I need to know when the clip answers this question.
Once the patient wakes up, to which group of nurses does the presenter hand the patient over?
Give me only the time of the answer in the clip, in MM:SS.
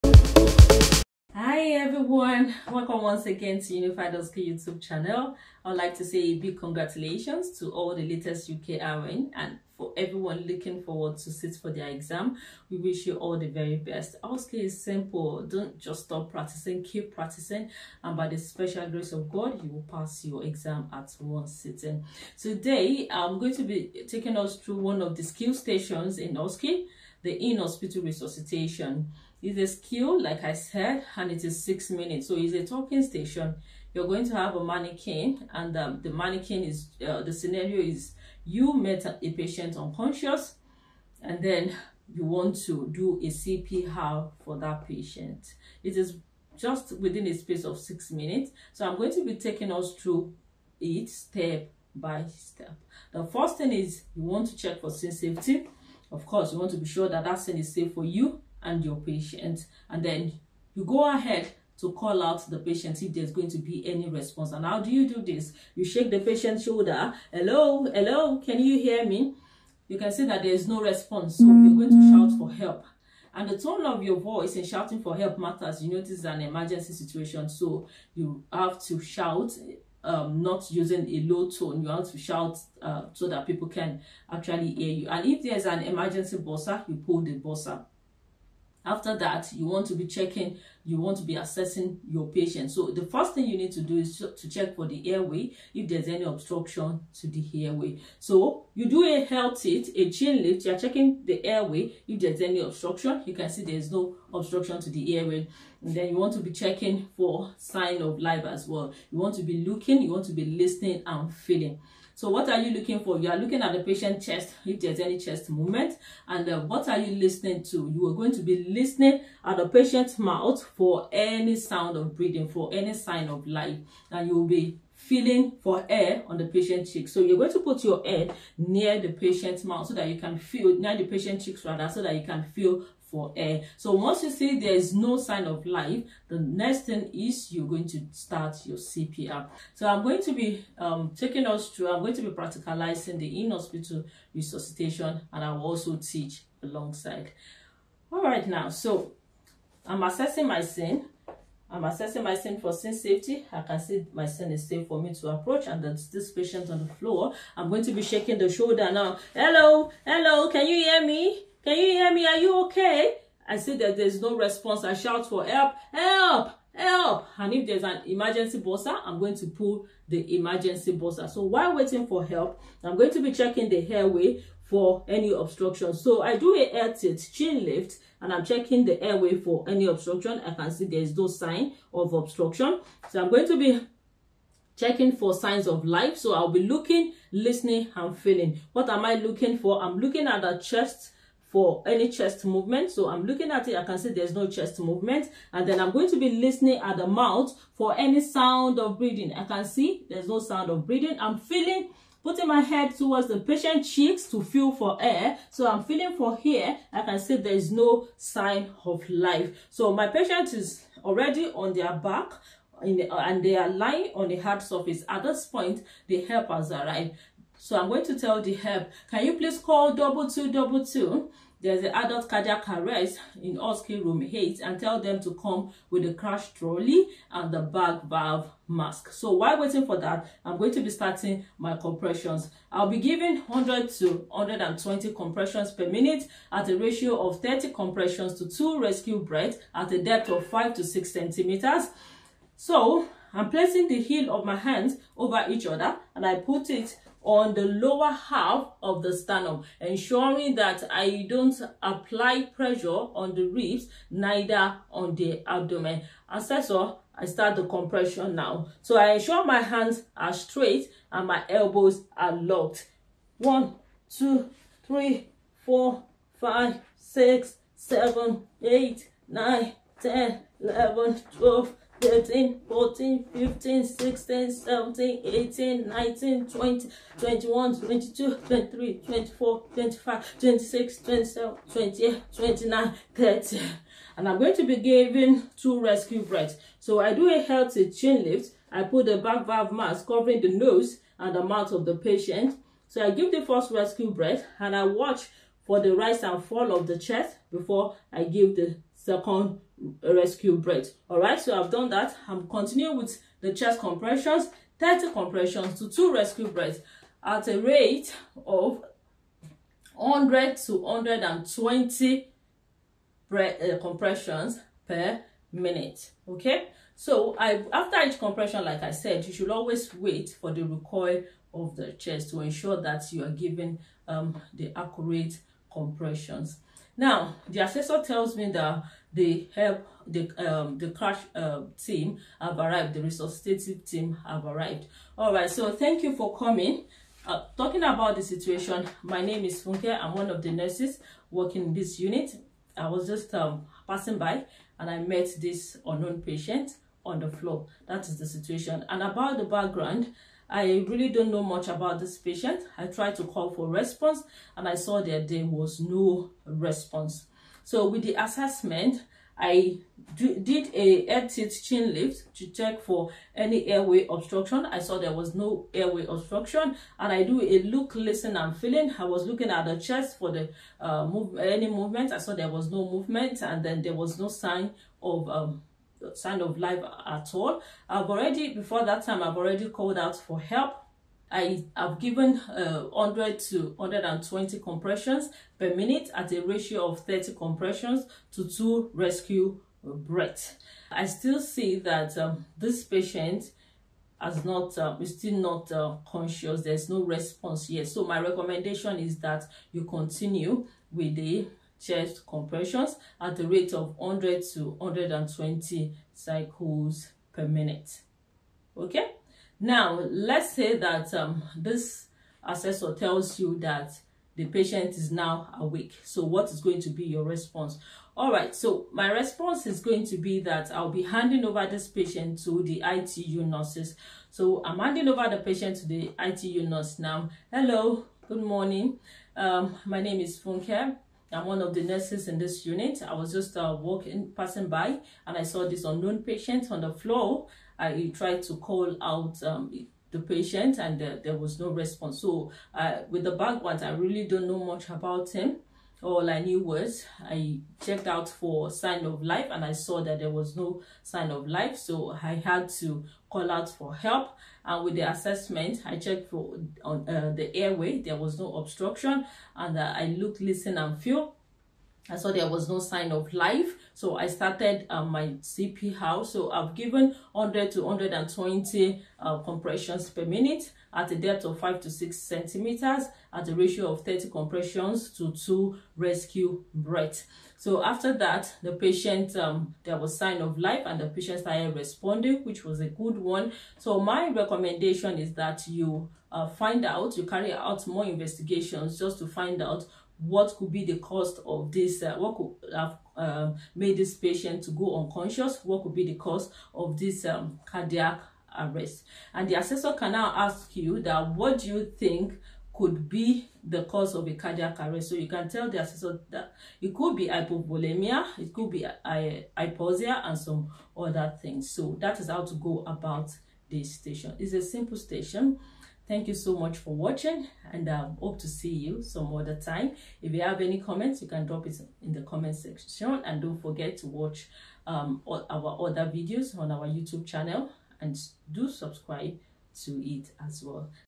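07:02.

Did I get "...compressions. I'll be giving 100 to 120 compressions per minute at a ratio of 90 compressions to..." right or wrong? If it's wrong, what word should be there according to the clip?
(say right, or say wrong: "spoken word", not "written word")
wrong: "30", not "90".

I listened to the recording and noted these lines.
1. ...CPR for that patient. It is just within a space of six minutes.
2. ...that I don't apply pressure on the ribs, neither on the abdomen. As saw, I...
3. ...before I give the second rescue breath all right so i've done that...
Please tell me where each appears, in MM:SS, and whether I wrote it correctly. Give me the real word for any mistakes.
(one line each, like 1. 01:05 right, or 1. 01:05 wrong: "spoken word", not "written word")
1. 00:43 right
2. 04:10 right
3. 04:57 right.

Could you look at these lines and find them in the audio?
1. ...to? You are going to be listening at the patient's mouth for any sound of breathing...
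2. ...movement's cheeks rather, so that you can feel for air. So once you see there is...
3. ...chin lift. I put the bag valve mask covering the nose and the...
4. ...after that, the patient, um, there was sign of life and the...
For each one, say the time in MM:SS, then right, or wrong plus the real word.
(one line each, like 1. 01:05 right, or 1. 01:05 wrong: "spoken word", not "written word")
1. 01:57 right
2. 02:11 wrong: "patient", not "movement"
3. 04:47 right
4. 07:57 right.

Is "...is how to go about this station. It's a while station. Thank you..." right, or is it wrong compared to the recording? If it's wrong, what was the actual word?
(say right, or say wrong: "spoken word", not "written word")
wrong: "simple", not "while".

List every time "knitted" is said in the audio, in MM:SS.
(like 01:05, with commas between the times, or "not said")
not said.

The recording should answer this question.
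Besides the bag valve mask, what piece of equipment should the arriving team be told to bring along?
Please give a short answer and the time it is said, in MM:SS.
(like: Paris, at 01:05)
crash trolley, at 03:46.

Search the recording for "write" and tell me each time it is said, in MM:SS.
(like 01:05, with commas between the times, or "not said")
not said.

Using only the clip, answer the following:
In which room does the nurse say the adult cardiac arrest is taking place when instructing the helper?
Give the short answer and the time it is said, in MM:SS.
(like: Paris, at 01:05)
Oski room 8, at 03:43.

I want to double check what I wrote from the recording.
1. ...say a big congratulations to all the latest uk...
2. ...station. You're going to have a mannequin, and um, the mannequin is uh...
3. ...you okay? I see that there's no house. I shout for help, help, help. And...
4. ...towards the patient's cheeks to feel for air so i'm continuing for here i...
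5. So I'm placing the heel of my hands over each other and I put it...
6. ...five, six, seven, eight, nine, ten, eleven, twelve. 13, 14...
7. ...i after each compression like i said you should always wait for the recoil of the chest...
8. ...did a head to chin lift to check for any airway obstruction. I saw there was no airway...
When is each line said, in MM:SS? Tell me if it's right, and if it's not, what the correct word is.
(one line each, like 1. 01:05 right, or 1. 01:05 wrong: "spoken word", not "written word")
1. 00:06 right
2. 00:33 right
3. 02:42 wrong: "response", not "house"
4. 03:22 wrong: "feeling", not "continuing"
5. 04:02 right
6. 04:26 right
7. 05:17 right
8. 06:00 right.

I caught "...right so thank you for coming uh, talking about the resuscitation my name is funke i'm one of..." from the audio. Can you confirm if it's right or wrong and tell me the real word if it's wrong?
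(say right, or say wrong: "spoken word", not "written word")
wrong: "situation", not "resuscitation".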